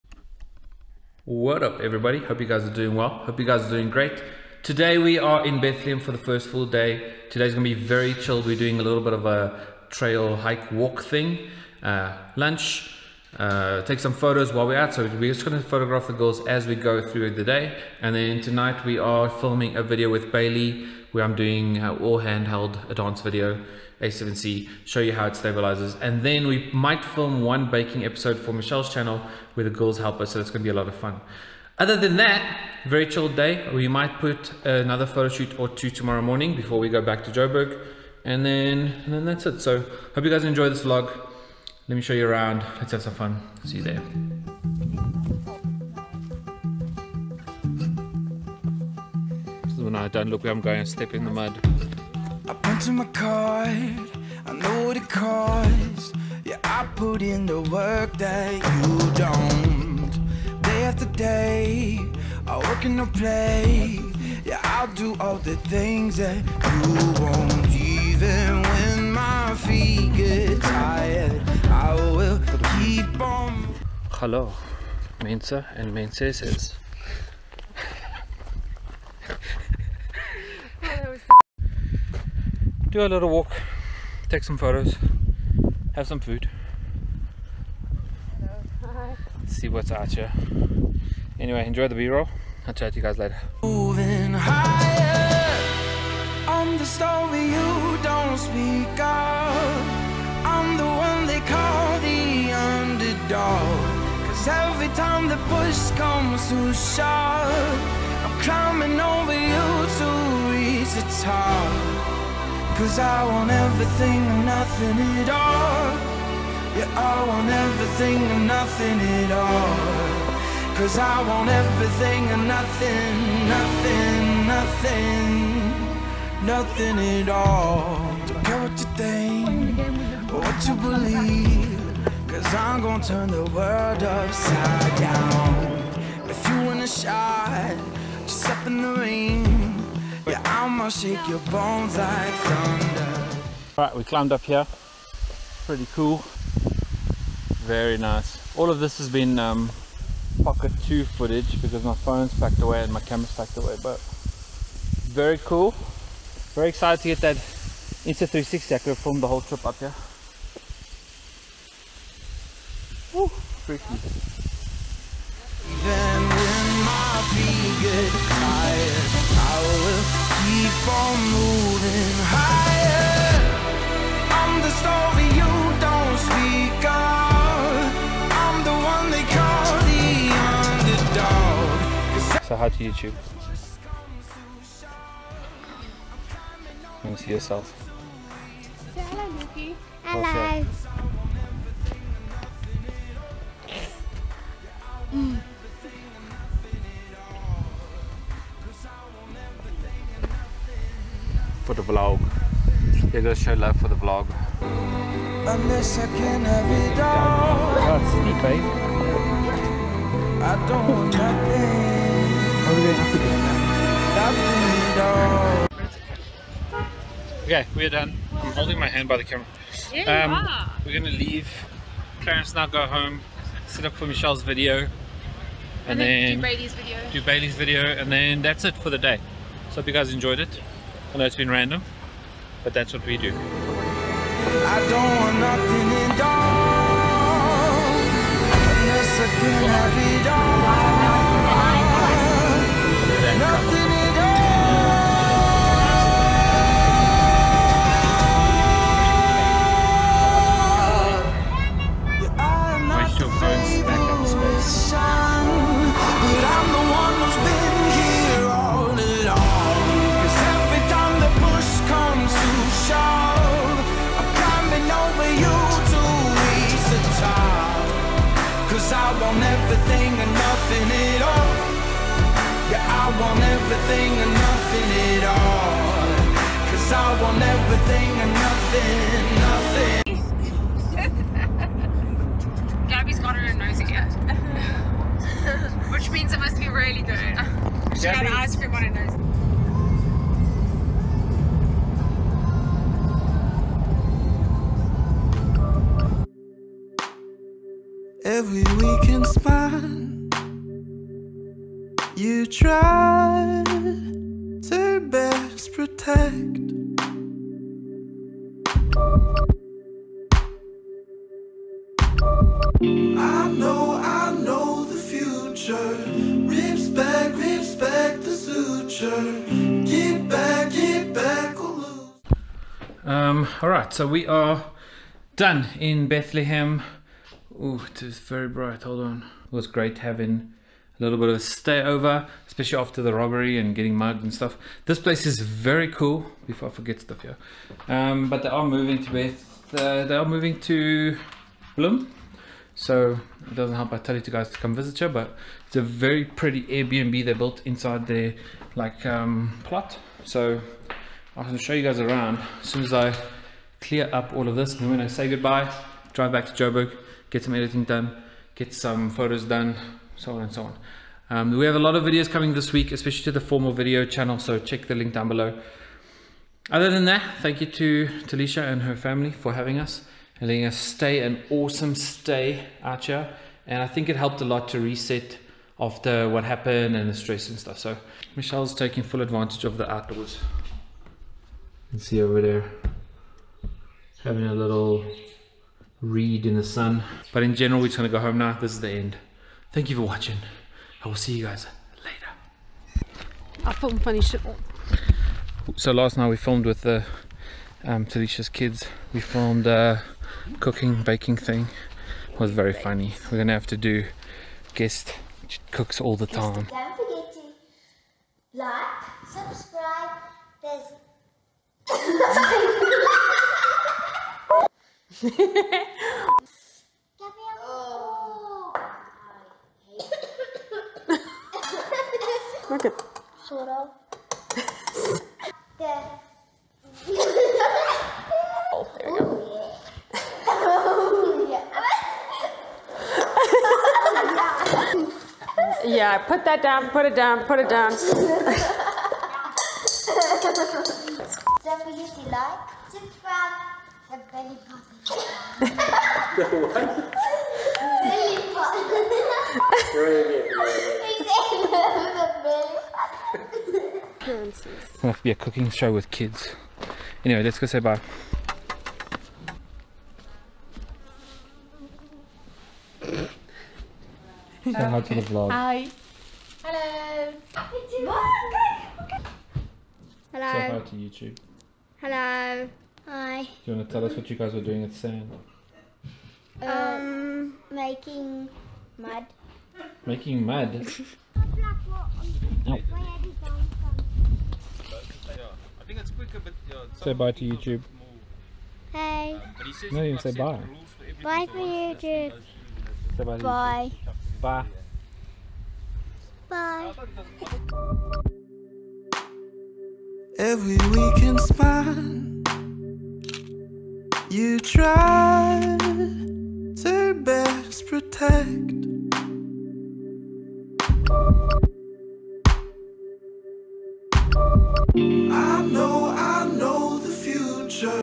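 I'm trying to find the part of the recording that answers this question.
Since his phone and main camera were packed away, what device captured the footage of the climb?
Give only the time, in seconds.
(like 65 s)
150 s.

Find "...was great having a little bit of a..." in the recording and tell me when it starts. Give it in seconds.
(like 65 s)
329 s.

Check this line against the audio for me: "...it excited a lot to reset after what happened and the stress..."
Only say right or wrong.
wrong.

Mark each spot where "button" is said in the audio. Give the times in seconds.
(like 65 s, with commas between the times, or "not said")
444 s, 450 s.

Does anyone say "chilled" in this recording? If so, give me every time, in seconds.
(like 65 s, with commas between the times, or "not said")
8 s, 33 s.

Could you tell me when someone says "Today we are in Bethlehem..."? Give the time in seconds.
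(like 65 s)
4 s.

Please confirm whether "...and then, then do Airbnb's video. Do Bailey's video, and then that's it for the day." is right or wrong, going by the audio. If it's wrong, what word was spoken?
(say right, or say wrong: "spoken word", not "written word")
wrong: "Bailey", not "Airbnb".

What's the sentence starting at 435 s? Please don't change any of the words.
yeah, put that down, put it down, put it down.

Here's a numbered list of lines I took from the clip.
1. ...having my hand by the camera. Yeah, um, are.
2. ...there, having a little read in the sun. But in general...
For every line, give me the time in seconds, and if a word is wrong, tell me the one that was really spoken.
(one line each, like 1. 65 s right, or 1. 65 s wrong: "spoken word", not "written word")
1. 218 s wrong: "holding", not "having"
2. 382 s right.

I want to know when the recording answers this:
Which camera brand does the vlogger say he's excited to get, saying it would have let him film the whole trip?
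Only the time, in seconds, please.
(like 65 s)
157 s.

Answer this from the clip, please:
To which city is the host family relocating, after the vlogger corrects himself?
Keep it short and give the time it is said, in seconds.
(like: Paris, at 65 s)
Bloem, at 341 s.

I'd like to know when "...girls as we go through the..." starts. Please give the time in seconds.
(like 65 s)
16 s.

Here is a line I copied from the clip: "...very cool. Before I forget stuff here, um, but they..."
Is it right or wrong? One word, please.
right.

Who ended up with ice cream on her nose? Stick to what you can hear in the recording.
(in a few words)
Gabby.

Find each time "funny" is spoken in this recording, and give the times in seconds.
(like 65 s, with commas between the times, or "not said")
394 s, 402 s.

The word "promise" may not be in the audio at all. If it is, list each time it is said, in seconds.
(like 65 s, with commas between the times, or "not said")
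not said.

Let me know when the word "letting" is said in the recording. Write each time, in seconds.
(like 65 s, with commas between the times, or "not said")
370 s.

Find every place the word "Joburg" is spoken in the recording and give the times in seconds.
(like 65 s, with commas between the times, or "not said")
37 s, 356 s.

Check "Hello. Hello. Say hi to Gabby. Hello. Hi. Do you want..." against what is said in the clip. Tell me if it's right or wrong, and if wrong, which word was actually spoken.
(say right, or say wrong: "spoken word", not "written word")
wrong: "YouTube", not "Gabby".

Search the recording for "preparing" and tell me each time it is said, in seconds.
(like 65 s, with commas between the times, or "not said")
not said.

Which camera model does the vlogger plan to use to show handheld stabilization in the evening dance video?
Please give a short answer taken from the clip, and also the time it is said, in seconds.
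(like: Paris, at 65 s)
A7C, at 24 s.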